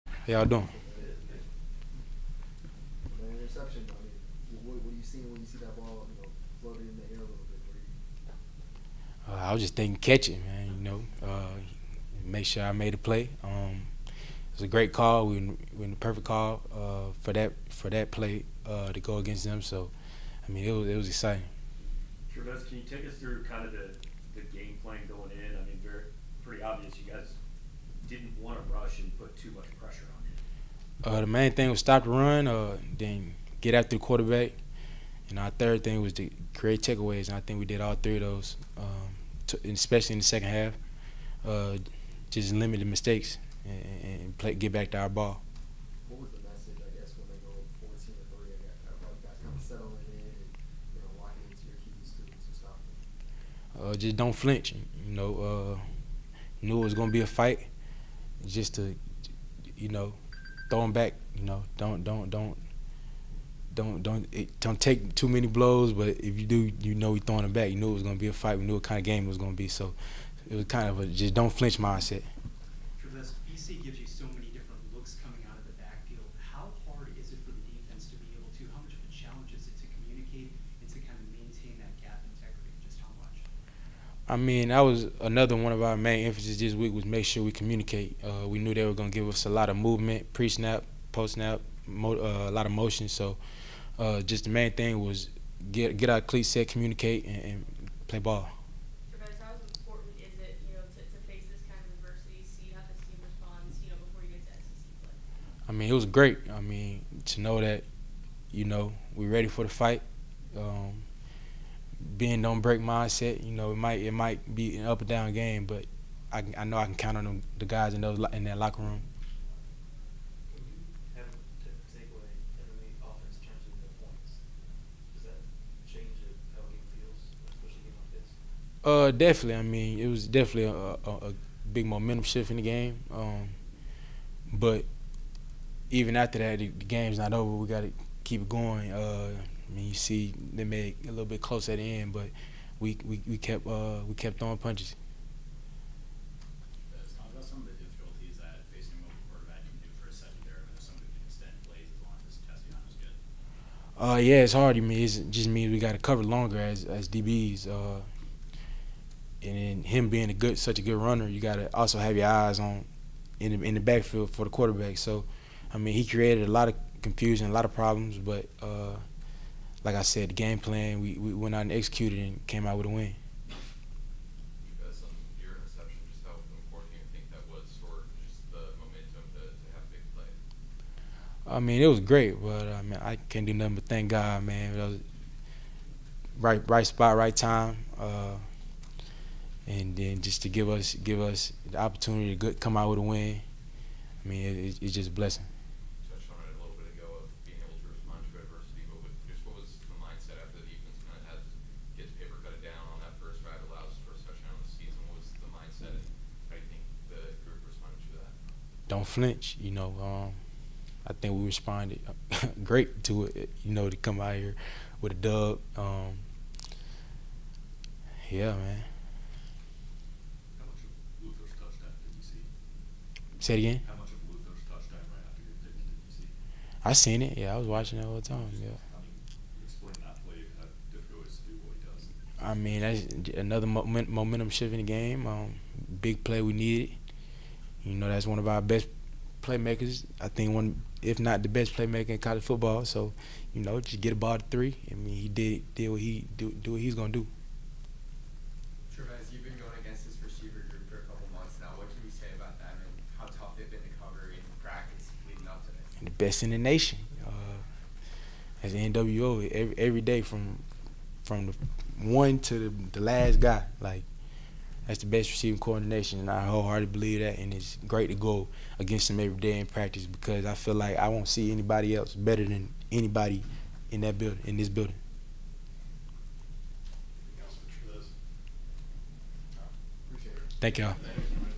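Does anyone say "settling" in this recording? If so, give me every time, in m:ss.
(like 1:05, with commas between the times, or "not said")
0:49.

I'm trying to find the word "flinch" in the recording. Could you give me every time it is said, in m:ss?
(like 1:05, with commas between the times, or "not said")
0:54, 1:11.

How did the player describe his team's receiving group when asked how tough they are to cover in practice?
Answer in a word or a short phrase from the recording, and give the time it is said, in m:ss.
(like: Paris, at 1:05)
the best in the nation, at 4:16.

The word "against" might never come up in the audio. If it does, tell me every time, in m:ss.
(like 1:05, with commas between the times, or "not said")
0:19, 4:09, 4:28.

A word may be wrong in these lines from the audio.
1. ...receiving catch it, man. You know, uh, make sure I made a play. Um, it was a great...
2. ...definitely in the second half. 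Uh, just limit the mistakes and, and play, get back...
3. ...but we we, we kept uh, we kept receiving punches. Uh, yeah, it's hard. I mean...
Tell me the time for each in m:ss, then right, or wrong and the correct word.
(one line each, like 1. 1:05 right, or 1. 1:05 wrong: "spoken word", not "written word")
1. 0:09 wrong: "thinking", not "receiving"
2. 0:39 wrong: "especially", not "definitely"
3. 2:22 wrong: "throwing", not "receiving".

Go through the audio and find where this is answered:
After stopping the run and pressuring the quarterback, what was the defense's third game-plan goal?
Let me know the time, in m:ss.
0:36.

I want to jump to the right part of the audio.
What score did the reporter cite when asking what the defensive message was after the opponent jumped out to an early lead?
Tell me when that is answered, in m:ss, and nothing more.
0:47.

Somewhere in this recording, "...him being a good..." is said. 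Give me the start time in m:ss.
2:39.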